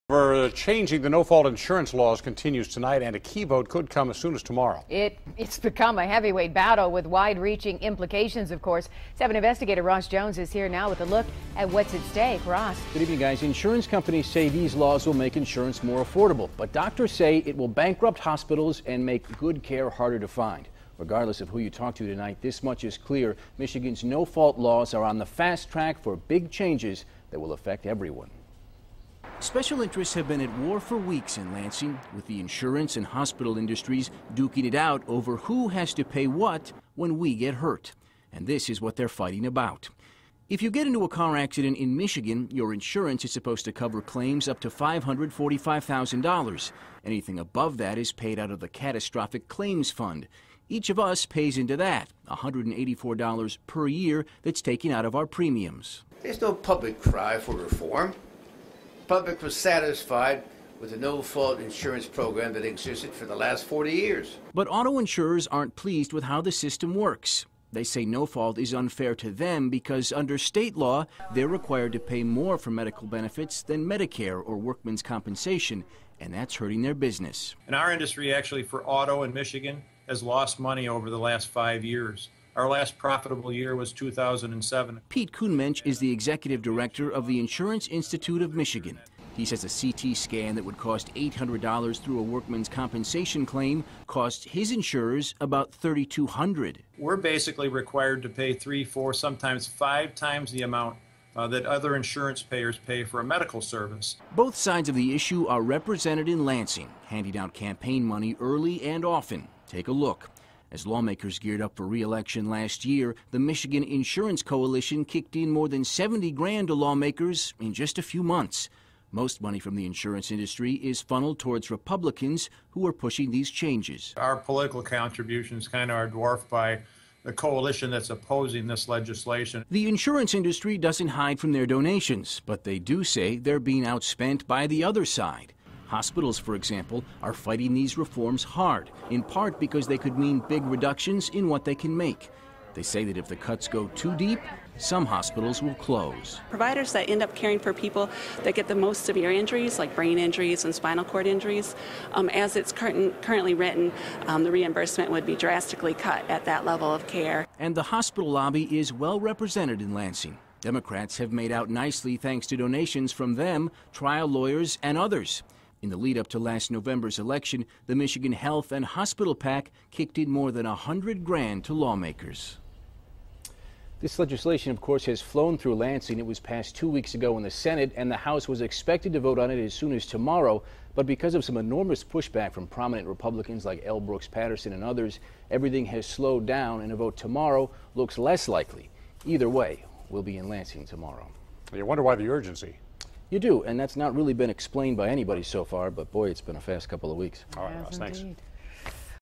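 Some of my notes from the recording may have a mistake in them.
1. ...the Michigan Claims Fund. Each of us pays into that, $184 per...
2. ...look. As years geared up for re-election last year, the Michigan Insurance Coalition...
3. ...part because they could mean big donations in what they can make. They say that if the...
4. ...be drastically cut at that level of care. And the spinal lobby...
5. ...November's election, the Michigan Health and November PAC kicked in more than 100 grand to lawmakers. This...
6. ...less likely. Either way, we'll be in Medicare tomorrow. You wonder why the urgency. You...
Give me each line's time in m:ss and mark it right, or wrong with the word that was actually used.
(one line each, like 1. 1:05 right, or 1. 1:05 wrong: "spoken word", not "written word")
1. 0:48 wrong: "Catastrophic", not "Michigan"
2. 1:49 wrong: "lawmakers", not "years"
3. 2:19 wrong: "reductions", not "donations"
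4. 2:35 wrong: "hospital", not "spinal"
5. 2:46 wrong: "Hospital", not "November"
6. 3:08 wrong: "Lansing", not "Medicare".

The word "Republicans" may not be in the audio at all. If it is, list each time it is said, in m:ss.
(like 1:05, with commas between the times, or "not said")
2:01, 3:03.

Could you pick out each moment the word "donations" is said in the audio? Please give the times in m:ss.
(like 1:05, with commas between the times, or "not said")
2:11, 2:42.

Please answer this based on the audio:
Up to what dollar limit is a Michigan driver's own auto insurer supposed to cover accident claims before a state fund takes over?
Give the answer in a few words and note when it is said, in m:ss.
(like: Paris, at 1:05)
$545,000, at 0:44.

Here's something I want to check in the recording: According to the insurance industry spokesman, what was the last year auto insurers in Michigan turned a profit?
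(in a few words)
2007.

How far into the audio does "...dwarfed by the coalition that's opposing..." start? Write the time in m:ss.
2:06.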